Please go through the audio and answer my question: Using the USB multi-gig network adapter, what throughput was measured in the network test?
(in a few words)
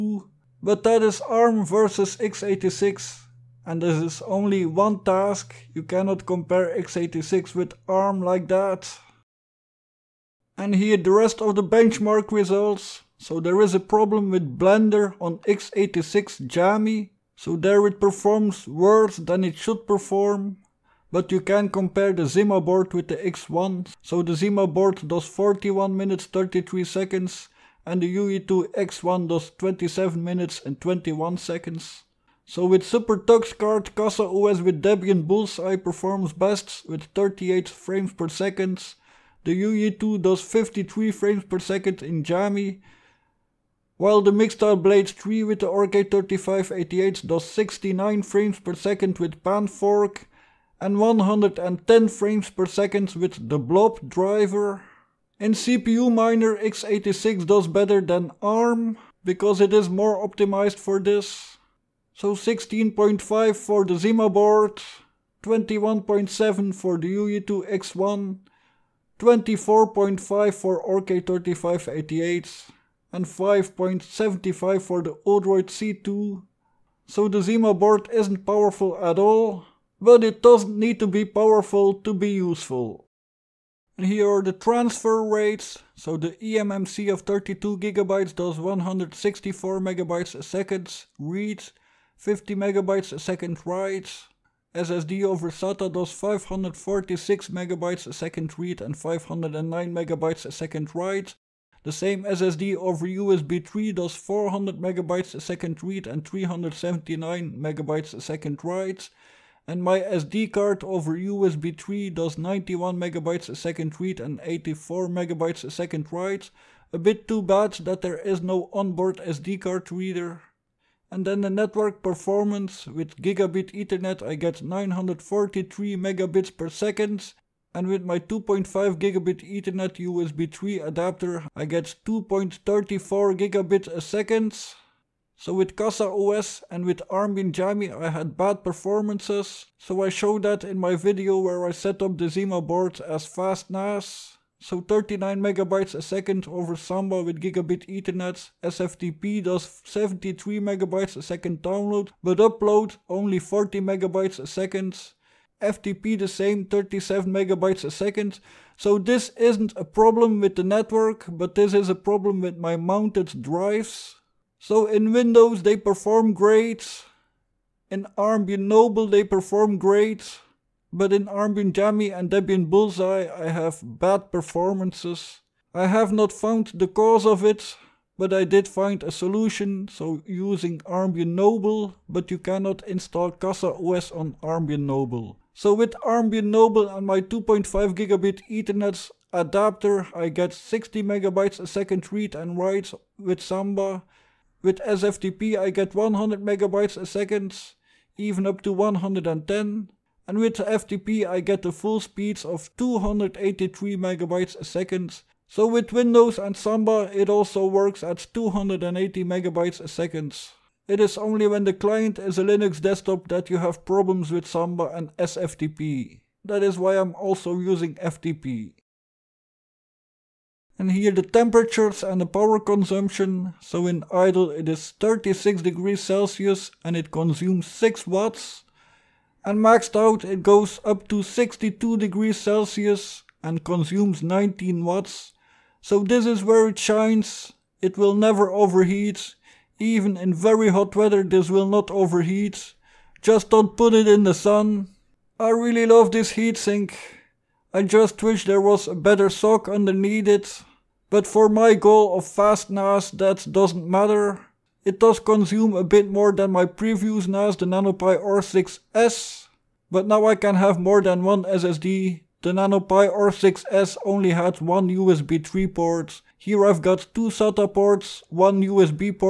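2.34 Gbps.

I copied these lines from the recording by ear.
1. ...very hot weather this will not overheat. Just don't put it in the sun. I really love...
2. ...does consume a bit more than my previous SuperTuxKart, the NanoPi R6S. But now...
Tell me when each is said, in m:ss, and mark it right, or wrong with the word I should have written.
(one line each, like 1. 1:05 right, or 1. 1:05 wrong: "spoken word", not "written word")
1. 4:00 right
2. 4:14 wrong: "NAS", not "SuperTuxKart".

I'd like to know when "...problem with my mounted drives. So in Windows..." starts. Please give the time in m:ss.
2:41.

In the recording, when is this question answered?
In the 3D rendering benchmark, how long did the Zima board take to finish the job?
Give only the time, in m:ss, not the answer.
0:25.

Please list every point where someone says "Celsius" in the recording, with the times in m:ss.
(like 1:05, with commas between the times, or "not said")
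3:45, 3:52.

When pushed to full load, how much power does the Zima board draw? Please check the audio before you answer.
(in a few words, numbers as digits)
19 watts.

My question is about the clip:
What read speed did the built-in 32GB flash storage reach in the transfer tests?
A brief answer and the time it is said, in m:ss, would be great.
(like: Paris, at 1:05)
164 MB/s, at 1:28.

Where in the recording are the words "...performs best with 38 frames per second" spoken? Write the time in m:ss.
0:35.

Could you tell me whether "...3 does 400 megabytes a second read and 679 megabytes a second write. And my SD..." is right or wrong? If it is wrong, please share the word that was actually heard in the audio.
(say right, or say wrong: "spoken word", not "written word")
wrong: "379", not "679".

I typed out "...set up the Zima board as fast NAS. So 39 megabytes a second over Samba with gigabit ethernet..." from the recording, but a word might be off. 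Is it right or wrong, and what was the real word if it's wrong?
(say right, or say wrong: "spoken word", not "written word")
right.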